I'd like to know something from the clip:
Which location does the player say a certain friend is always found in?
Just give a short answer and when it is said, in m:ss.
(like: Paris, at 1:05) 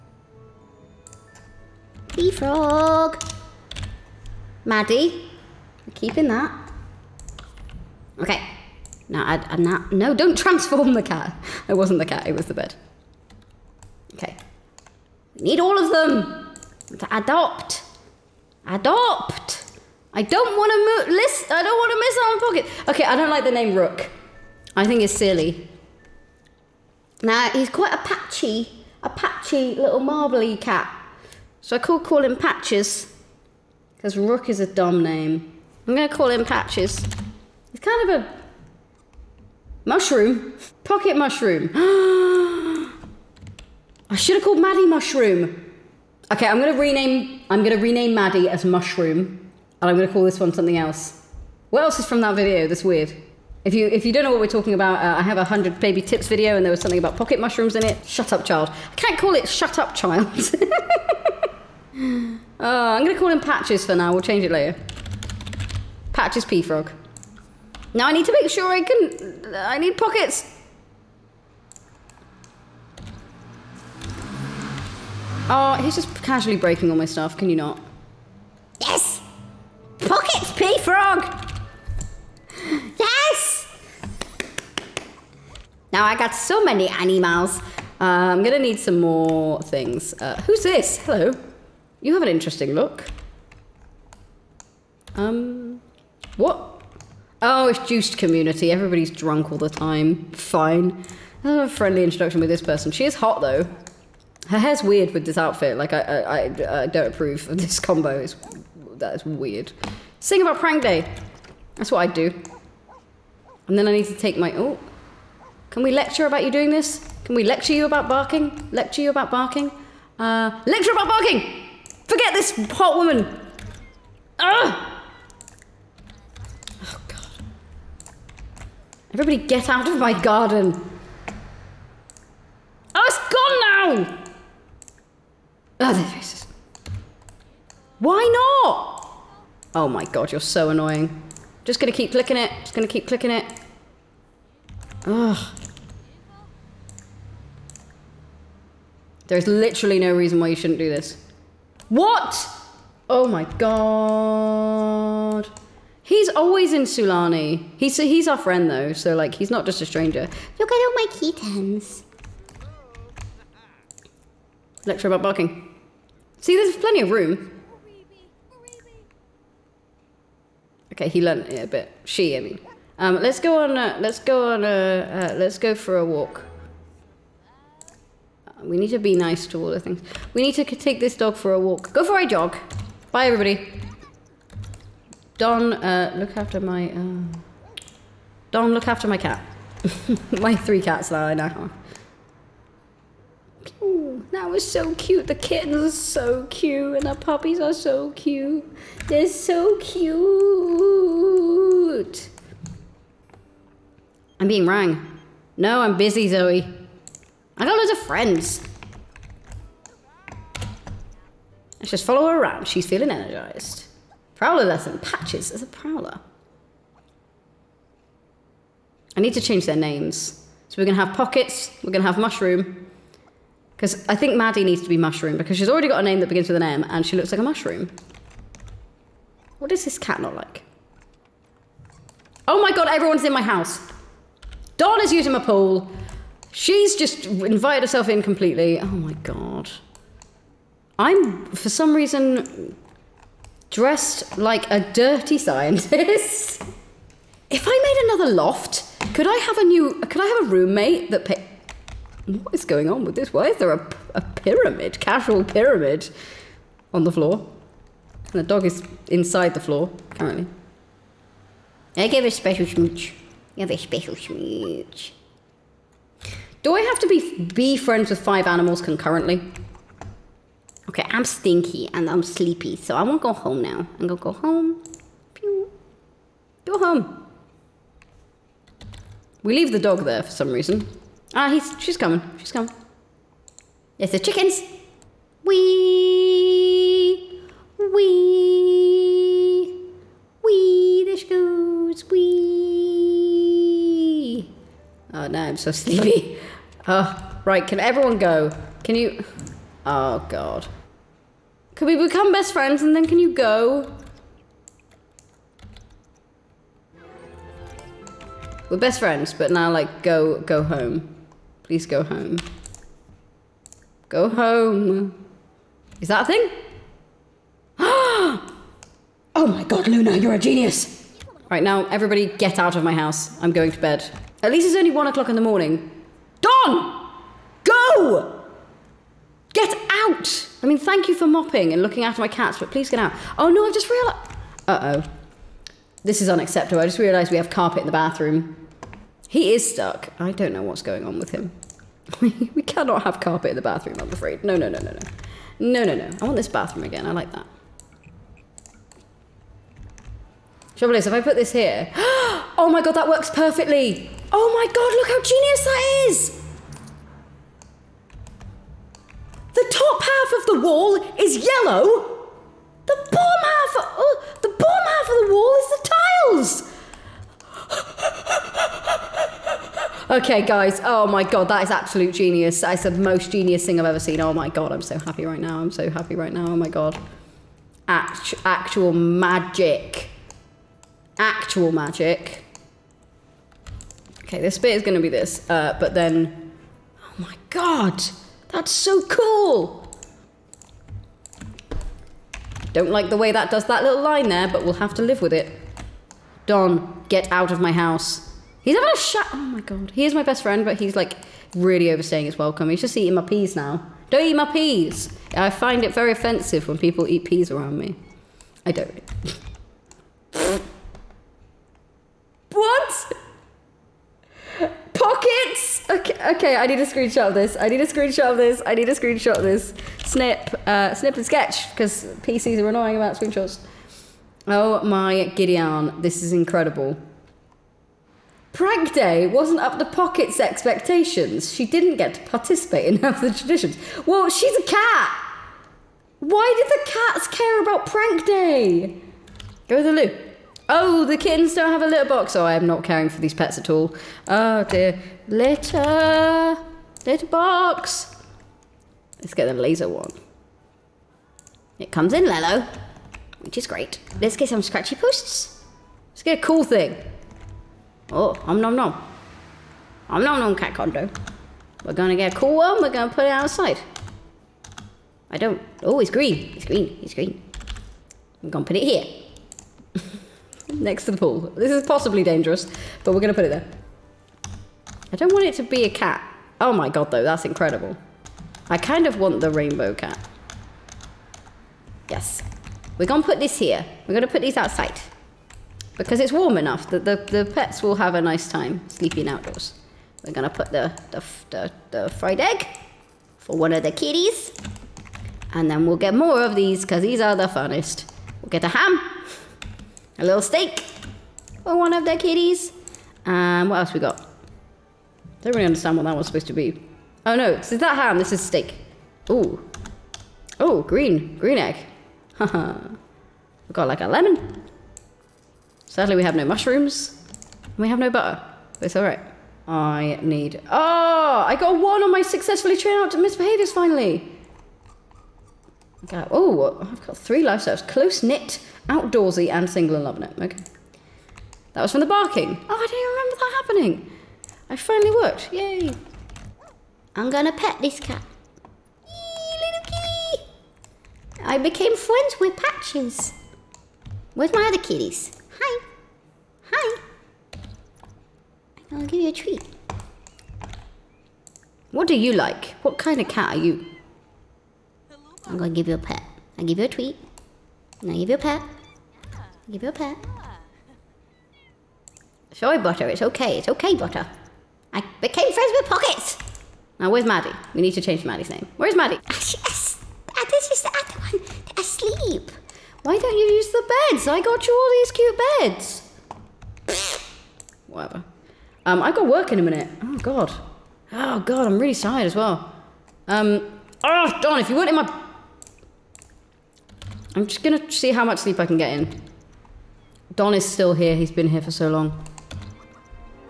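Sulani, at 2:36.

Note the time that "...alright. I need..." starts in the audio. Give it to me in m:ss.
8:38.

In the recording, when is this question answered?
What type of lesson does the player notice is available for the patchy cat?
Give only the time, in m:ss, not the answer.
3:34.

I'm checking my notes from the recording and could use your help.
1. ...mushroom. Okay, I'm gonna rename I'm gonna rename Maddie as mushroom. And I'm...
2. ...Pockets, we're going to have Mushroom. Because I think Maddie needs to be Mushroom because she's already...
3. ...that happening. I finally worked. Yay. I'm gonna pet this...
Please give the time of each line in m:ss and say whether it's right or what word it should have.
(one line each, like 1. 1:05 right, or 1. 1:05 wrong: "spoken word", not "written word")
1. 0:44 right
2. 3:41 right
3. 8:53 right.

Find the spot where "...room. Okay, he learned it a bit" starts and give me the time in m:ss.
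2:47.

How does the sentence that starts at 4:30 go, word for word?
Okay, I'm stinky and I'm sleepy, so I won't go home now.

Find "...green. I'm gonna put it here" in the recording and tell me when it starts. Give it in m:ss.
7:47.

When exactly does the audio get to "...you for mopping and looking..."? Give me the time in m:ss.
5:31.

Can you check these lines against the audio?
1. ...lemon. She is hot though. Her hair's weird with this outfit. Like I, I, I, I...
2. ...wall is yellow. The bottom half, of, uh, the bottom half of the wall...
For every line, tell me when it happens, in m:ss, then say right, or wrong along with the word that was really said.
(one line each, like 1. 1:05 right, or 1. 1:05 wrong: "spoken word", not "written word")
1. 1:42 wrong: "person", not "lemon"
2. 6:00 right.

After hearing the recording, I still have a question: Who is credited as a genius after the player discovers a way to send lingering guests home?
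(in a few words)
Luna.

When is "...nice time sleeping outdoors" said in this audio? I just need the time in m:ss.
8:08.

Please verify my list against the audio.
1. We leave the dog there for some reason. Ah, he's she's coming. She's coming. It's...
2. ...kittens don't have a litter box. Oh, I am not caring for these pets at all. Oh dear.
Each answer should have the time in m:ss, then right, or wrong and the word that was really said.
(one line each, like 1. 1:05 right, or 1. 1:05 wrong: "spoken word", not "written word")
1. 4:39 right
2. 7:21 right.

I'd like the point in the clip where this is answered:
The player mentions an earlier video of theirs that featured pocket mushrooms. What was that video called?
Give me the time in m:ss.
0:55.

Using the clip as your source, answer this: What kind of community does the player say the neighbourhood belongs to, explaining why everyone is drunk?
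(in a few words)
juiced community.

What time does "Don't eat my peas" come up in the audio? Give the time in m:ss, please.
6:44.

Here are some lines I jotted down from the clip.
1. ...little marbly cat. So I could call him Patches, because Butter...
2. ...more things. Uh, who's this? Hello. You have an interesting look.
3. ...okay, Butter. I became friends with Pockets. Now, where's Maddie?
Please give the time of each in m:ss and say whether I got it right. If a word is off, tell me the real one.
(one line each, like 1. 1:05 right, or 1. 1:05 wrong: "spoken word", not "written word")
1. 0:29 wrong: "Rook", not "Butter"
2. 1:28 right
3. 9:23 right.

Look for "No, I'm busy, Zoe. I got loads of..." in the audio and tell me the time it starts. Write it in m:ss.
3:25.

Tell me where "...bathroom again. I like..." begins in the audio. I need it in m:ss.
5:46.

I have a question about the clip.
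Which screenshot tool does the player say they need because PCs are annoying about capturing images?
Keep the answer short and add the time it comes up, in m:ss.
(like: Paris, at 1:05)
Snip and sketch, at 7:00.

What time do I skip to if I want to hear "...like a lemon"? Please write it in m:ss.
8:33.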